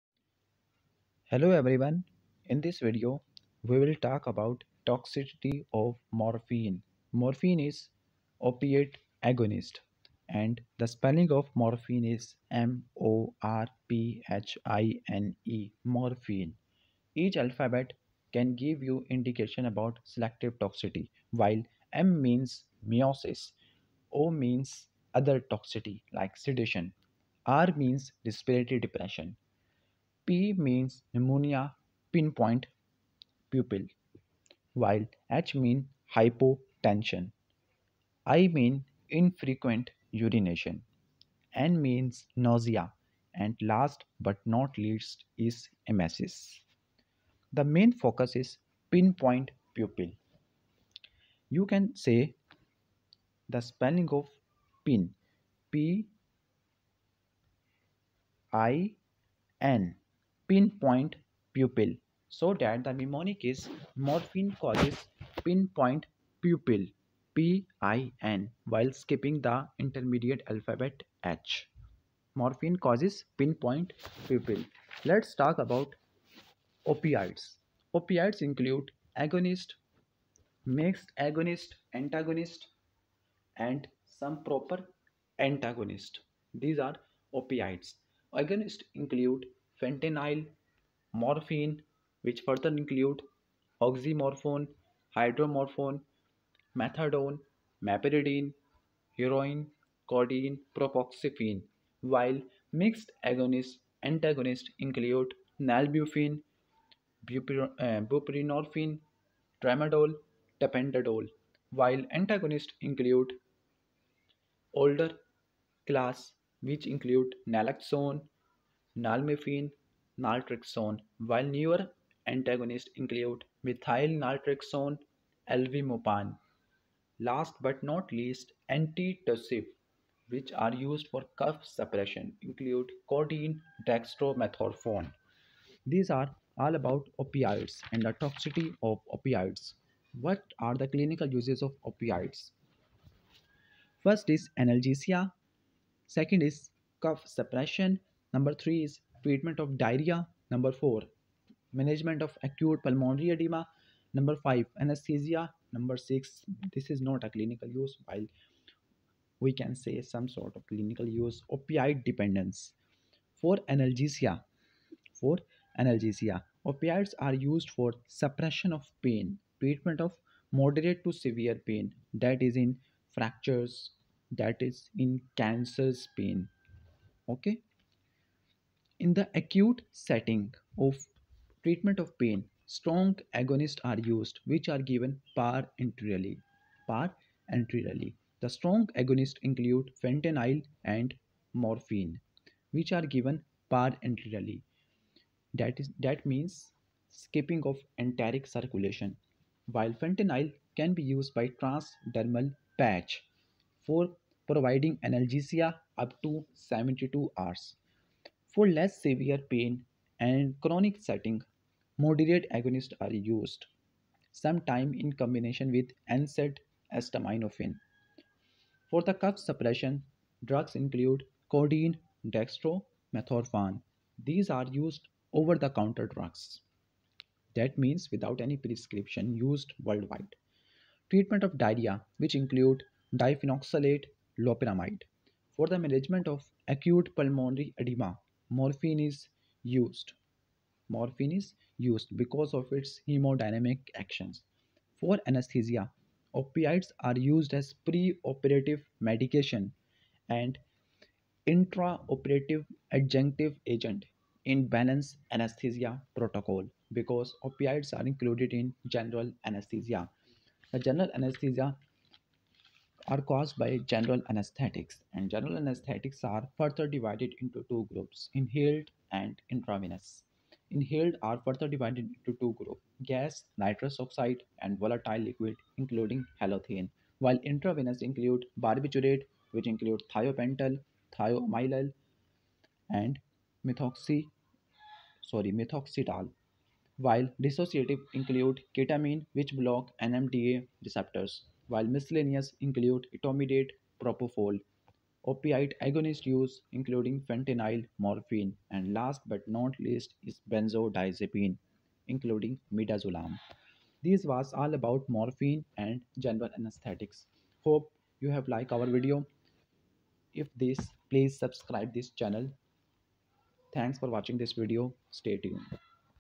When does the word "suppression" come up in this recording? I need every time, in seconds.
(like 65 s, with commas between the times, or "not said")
131 s, 147 s, 168 s, 219 s.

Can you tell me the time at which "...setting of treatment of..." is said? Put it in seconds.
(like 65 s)
179 s.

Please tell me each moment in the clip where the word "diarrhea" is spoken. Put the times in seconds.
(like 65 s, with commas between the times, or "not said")
149 s, 231 s.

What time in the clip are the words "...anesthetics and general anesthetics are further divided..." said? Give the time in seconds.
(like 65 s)
264 s.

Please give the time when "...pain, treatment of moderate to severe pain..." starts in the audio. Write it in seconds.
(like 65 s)
169 s.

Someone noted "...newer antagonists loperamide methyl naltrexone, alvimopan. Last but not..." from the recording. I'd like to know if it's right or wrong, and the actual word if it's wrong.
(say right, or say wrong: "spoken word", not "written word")
wrong: "include", not "loperamide".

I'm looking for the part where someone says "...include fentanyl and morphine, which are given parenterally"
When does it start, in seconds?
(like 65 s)
189 s.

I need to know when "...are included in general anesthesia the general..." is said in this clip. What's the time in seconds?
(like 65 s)
257 s.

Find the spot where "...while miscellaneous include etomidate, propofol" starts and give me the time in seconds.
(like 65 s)
291 s.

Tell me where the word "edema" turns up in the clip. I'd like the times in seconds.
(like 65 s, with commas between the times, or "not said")
153 s, 237 s.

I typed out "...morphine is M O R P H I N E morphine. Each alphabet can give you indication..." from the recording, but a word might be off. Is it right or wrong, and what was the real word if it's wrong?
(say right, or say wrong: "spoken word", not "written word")
right.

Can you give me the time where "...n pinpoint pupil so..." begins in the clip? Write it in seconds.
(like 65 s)
59 s.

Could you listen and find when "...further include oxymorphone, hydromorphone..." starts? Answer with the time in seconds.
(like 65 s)
92 s.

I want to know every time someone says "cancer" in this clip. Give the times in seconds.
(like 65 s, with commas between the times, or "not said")
175 s.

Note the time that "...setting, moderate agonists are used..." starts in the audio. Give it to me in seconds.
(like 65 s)
211 s.